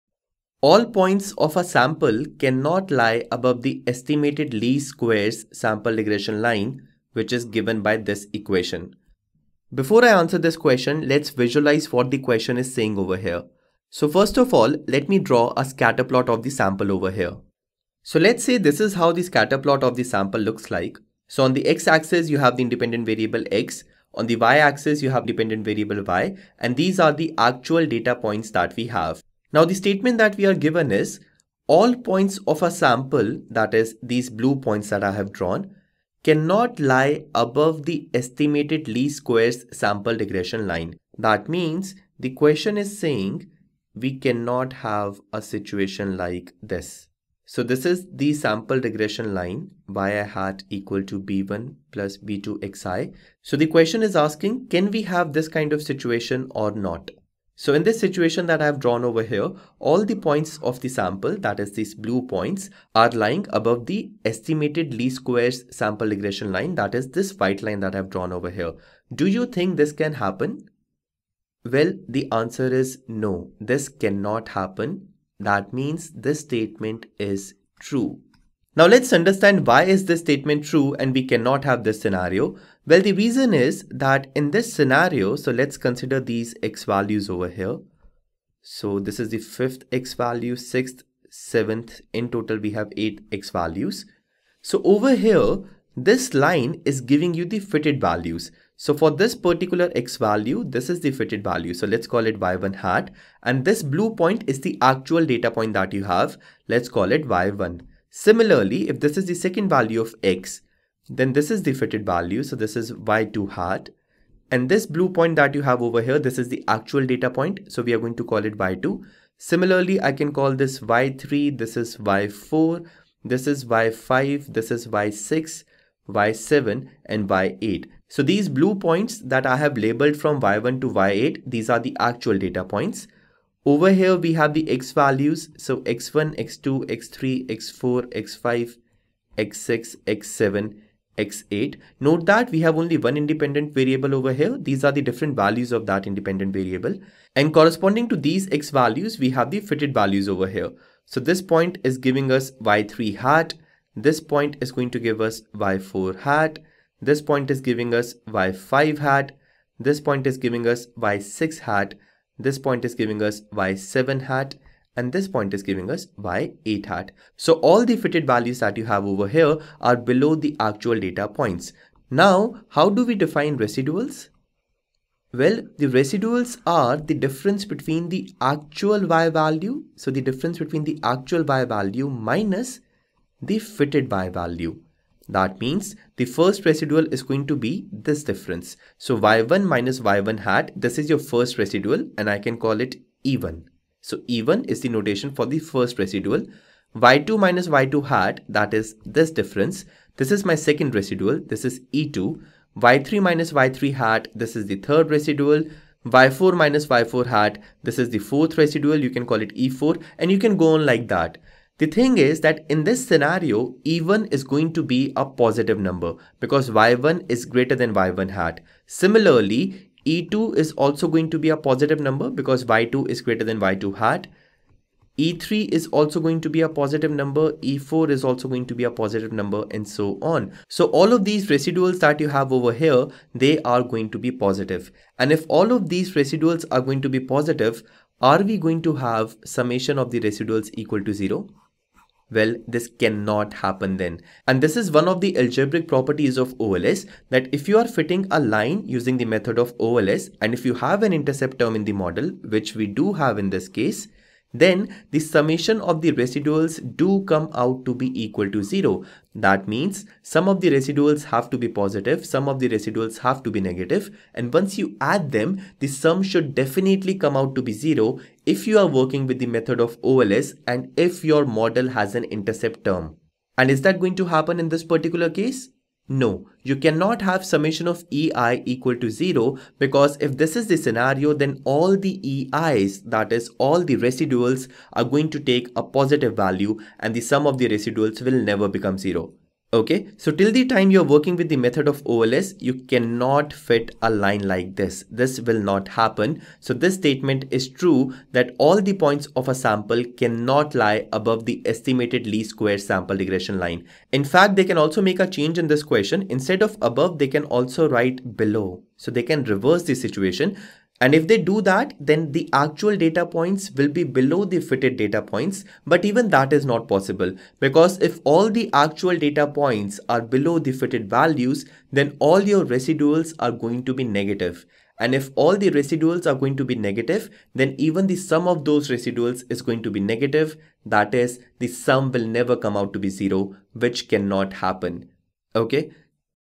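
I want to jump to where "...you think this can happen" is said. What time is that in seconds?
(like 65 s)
69 s.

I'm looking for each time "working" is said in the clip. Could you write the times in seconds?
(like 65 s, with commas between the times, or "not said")
268 s, 291 s.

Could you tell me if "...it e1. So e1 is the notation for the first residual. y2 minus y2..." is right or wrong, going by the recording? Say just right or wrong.
right.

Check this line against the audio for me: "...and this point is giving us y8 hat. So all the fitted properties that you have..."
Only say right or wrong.
wrong.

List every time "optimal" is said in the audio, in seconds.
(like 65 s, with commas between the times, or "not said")
not said.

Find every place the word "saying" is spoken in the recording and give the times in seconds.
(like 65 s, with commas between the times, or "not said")
12 s, 42 s.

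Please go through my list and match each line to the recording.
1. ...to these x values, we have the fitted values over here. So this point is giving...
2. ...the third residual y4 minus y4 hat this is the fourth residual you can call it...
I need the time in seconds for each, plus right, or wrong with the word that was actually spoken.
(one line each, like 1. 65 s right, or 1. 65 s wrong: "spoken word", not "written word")
1. 148 s right
2. 204 s right.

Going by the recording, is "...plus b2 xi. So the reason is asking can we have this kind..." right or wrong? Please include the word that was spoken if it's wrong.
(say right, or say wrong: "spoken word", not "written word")
wrong: "question", not "reason".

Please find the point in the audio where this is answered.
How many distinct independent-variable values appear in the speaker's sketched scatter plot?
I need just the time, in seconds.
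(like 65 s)
92 s.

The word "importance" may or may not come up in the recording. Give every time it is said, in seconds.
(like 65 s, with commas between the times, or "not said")
not said.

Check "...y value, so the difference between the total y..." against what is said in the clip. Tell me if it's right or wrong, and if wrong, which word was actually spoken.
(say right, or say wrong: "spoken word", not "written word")
wrong: "actual", not "total".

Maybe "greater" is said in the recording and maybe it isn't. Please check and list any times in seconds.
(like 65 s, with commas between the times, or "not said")
217 s, 223 s.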